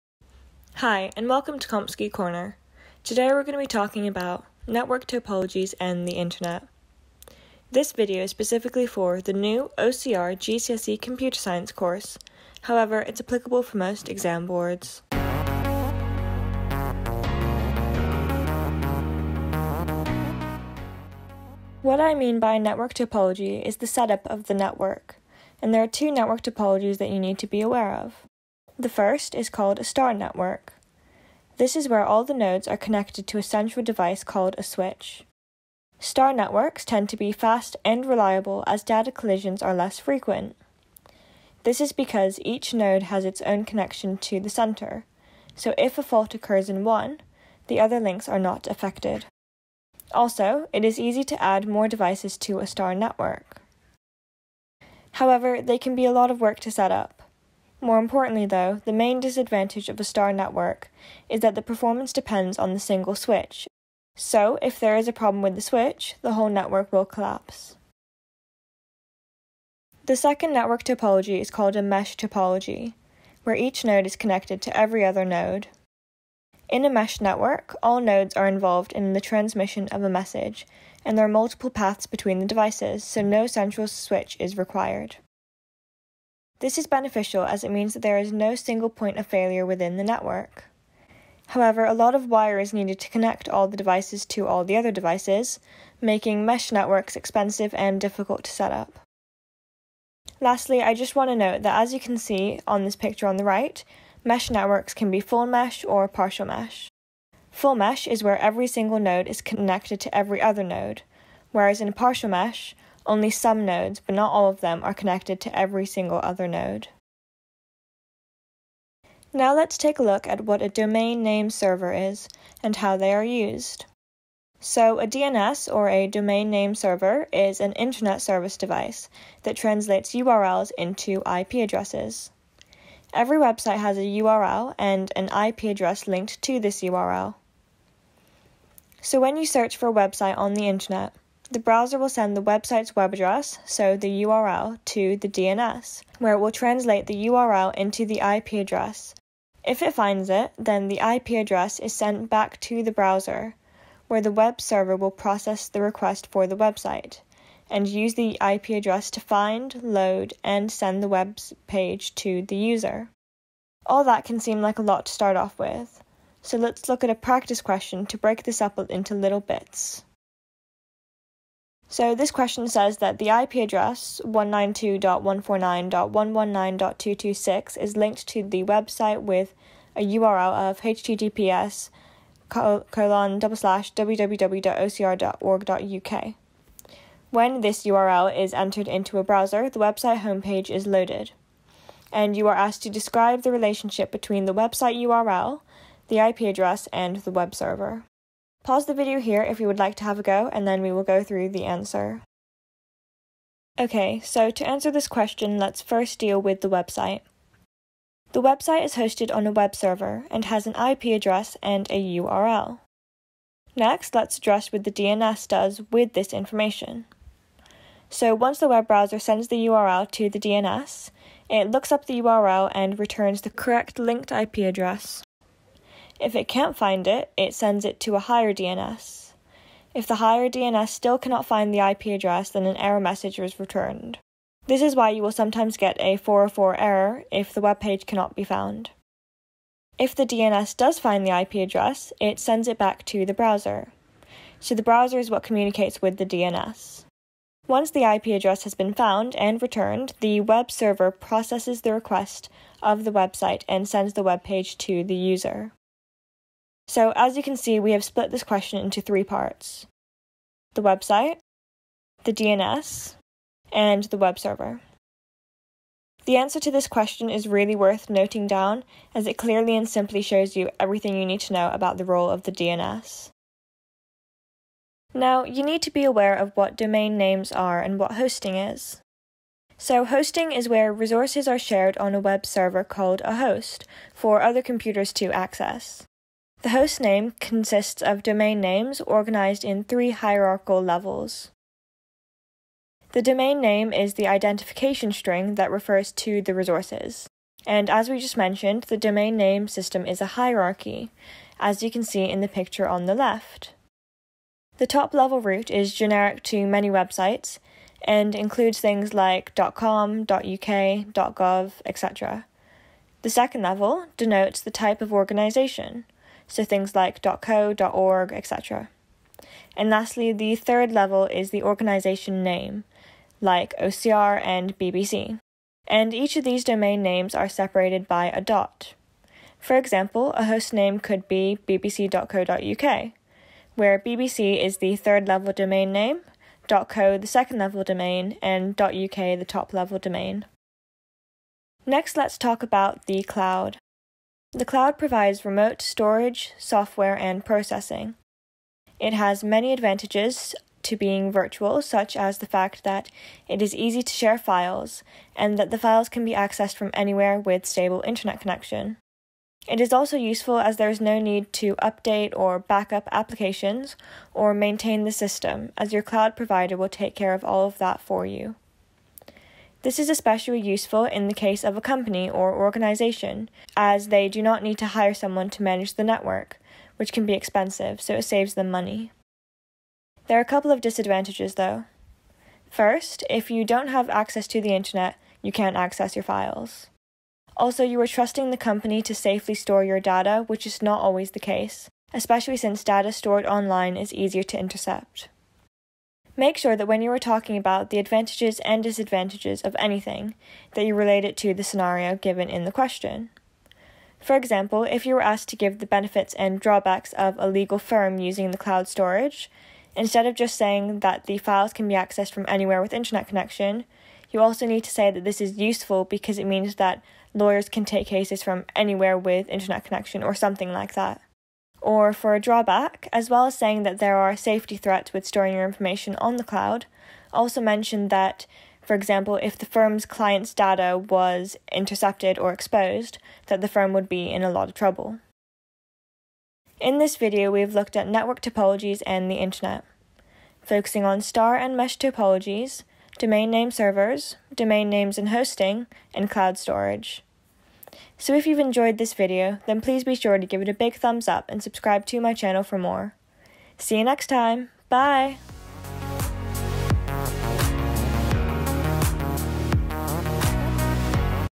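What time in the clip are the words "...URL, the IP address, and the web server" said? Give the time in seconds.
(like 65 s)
194 s.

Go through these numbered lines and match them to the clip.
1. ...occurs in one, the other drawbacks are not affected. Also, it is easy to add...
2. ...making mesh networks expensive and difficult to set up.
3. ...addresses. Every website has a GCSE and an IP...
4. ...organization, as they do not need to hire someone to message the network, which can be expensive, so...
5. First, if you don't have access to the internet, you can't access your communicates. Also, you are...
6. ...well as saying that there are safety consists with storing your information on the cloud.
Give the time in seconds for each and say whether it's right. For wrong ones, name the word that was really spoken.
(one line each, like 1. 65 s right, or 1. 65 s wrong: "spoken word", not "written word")
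1. 46 s wrong: "links", not "drawbacks"
2. 96 s right
3. 131 s wrong: "URL", not "GCSE"
4. 372 s wrong: "manage", not "message"
5. 382 s wrong: "files", not "communicates"
6. 423 s wrong: "threats", not "consists".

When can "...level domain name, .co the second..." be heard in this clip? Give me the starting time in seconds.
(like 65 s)
335 s.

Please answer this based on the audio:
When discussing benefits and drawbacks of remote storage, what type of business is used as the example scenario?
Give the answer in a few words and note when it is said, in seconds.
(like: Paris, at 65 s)
legal firm, at 407 s.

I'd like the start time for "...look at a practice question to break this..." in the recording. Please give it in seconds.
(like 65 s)
166 s.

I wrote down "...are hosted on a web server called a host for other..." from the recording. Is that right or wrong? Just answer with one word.
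wrong.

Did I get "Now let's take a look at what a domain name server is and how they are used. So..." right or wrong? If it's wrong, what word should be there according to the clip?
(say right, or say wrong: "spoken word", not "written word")
right.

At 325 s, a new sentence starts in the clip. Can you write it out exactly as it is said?
And each of these domain names are separated by a dot.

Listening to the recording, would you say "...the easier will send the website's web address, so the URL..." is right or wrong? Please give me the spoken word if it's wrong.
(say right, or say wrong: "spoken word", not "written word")
wrong: "browser", not "easier".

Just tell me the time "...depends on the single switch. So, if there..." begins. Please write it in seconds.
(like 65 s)
62 s.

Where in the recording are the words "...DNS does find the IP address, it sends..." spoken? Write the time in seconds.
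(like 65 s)
240 s.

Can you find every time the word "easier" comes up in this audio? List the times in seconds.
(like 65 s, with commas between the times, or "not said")
394 s.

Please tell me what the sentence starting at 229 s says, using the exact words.
If the higher DNS still cannot find the IP address, then an error message is returned.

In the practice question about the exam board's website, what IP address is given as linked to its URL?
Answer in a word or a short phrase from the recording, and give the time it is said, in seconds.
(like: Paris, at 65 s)
192.149.119.226, at 174 s.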